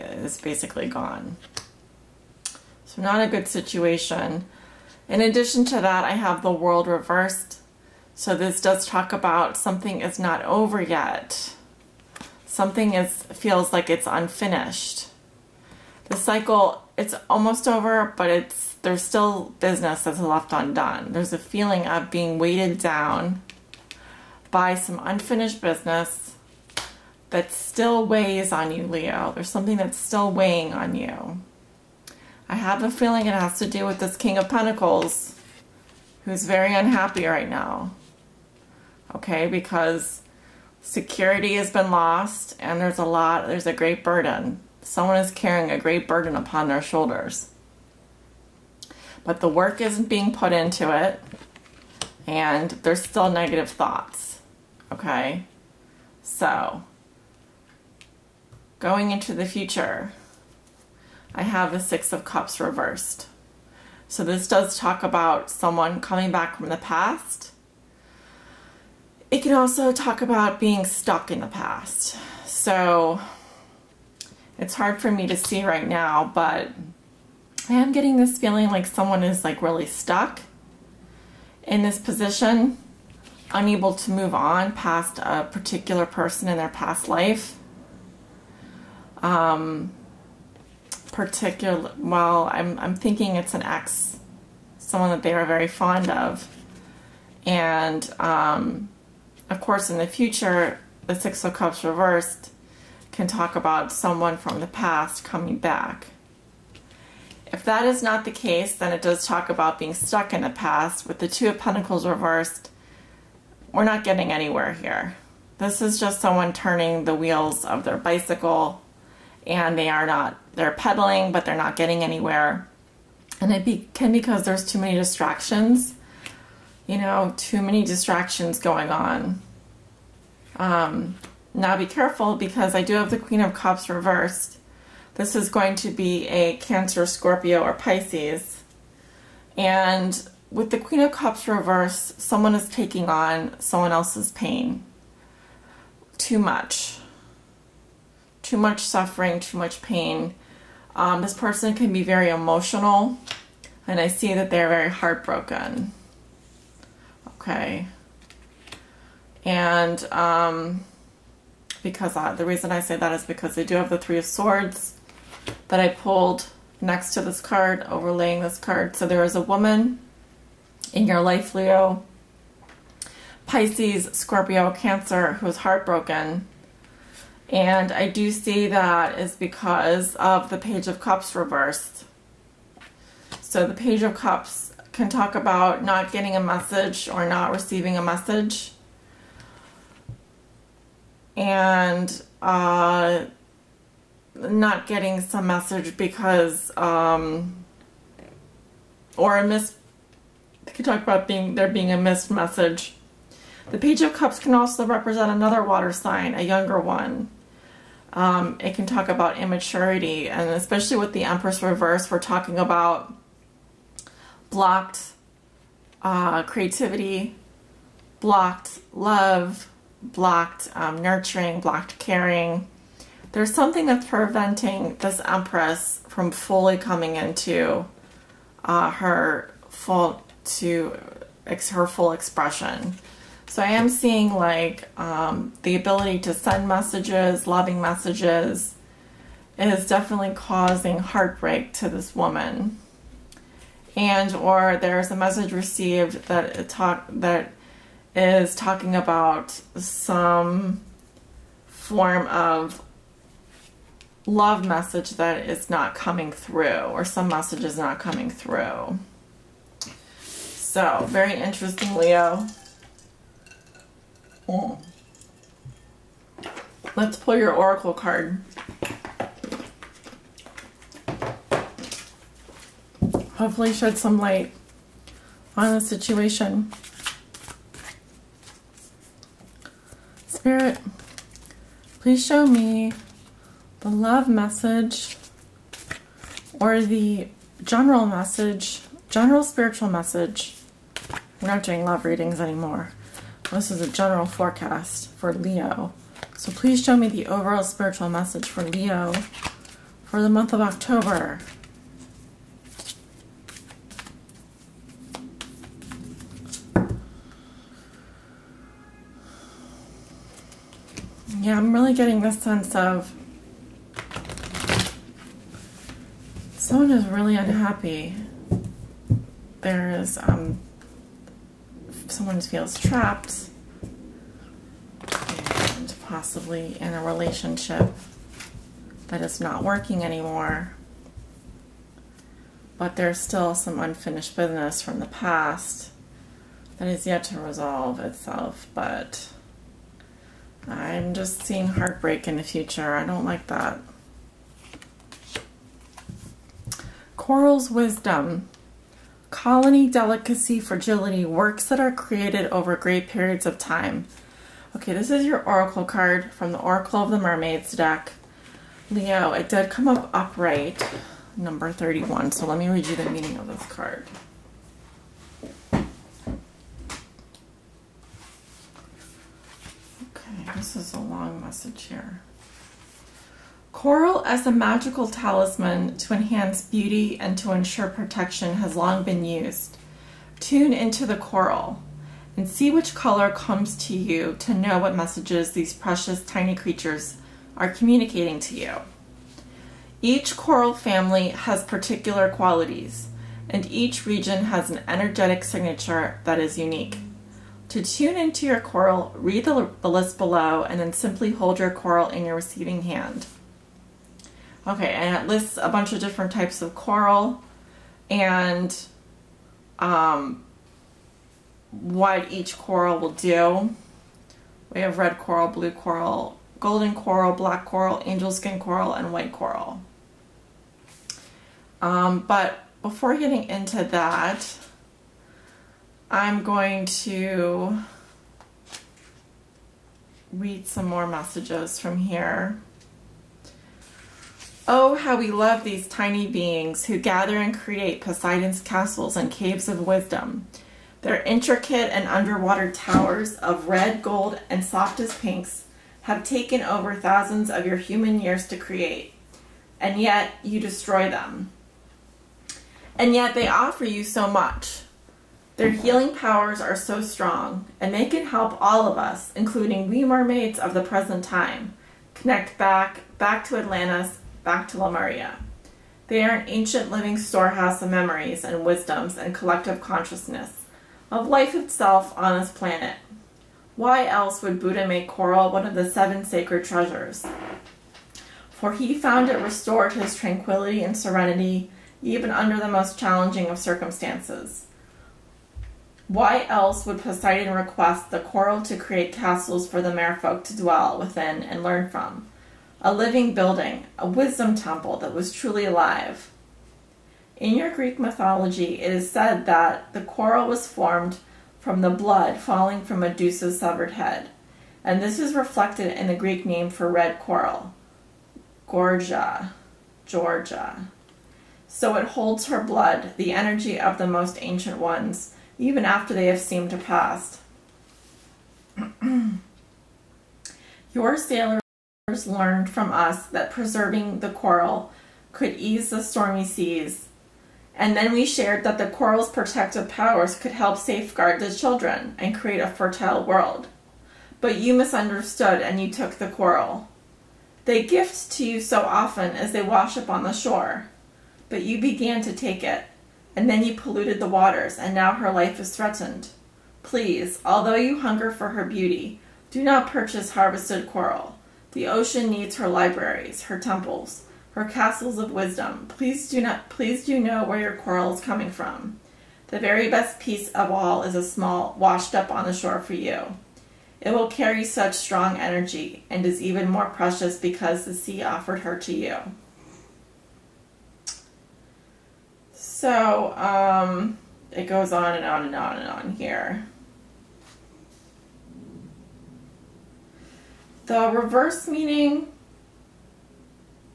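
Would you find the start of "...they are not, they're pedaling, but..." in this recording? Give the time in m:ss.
1:59.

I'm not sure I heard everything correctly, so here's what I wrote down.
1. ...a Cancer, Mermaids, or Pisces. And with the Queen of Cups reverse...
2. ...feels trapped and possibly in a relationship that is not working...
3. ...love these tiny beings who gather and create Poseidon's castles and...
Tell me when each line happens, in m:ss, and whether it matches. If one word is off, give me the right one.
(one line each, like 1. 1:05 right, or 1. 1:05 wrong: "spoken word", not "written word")
1. 2:16 wrong: "Scorpio", not "Mermaids"
2. 5:22 right
3. 7:15 right.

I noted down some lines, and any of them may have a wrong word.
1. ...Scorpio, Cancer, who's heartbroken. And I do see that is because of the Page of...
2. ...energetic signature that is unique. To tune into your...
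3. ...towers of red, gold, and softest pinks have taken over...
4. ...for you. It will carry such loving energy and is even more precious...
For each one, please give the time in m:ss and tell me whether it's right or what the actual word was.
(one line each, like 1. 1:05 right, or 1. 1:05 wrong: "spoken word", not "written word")
1. 2:54 right
2. 6:34 right
3. 7:22 right
4. 9:22 wrong: "strong", not "loving".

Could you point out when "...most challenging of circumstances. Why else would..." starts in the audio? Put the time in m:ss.
8:02.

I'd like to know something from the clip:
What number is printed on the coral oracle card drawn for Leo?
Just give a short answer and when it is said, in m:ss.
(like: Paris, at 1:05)
31, at 6:01.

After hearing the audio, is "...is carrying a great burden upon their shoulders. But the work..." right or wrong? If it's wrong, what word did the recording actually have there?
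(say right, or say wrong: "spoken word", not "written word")
right.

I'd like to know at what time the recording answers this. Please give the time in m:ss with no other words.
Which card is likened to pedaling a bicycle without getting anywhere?
1:51.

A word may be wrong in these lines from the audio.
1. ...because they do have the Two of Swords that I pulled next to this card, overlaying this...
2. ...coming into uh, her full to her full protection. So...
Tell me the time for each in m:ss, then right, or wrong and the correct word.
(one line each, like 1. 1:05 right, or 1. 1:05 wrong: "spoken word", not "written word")
1. 2:43 wrong: "Three", not "Two"
2. 3:46 wrong: "expression", not "protection".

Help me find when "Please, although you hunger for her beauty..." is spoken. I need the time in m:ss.
9:06.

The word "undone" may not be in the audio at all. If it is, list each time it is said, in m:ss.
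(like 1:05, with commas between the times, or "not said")
0:20.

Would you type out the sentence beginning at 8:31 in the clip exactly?
So it holds her blood, the energy of the most ancient ones, even after they have seemed to pass.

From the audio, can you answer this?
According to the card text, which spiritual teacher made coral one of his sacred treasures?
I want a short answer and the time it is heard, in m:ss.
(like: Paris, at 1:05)
Buddha, at 7:54.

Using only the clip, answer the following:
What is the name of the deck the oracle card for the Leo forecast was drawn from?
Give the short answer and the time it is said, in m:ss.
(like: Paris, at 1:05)
Oracle of the Mermaids, at 5:56.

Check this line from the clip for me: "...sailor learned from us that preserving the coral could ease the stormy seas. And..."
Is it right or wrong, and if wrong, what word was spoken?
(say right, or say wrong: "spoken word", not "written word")
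right.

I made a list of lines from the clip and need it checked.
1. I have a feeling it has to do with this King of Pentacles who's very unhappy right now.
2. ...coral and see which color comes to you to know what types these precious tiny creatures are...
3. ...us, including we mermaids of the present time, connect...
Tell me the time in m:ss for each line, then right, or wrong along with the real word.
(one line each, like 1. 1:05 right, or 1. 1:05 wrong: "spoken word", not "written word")
1. 0:32 right
2. 6:21 wrong: "messages", not "types"
3. 7:38 right.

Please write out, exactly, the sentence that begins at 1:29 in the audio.
Um, particular, well, I'm, I'm thinking it's an ex, someone that they are very fond of.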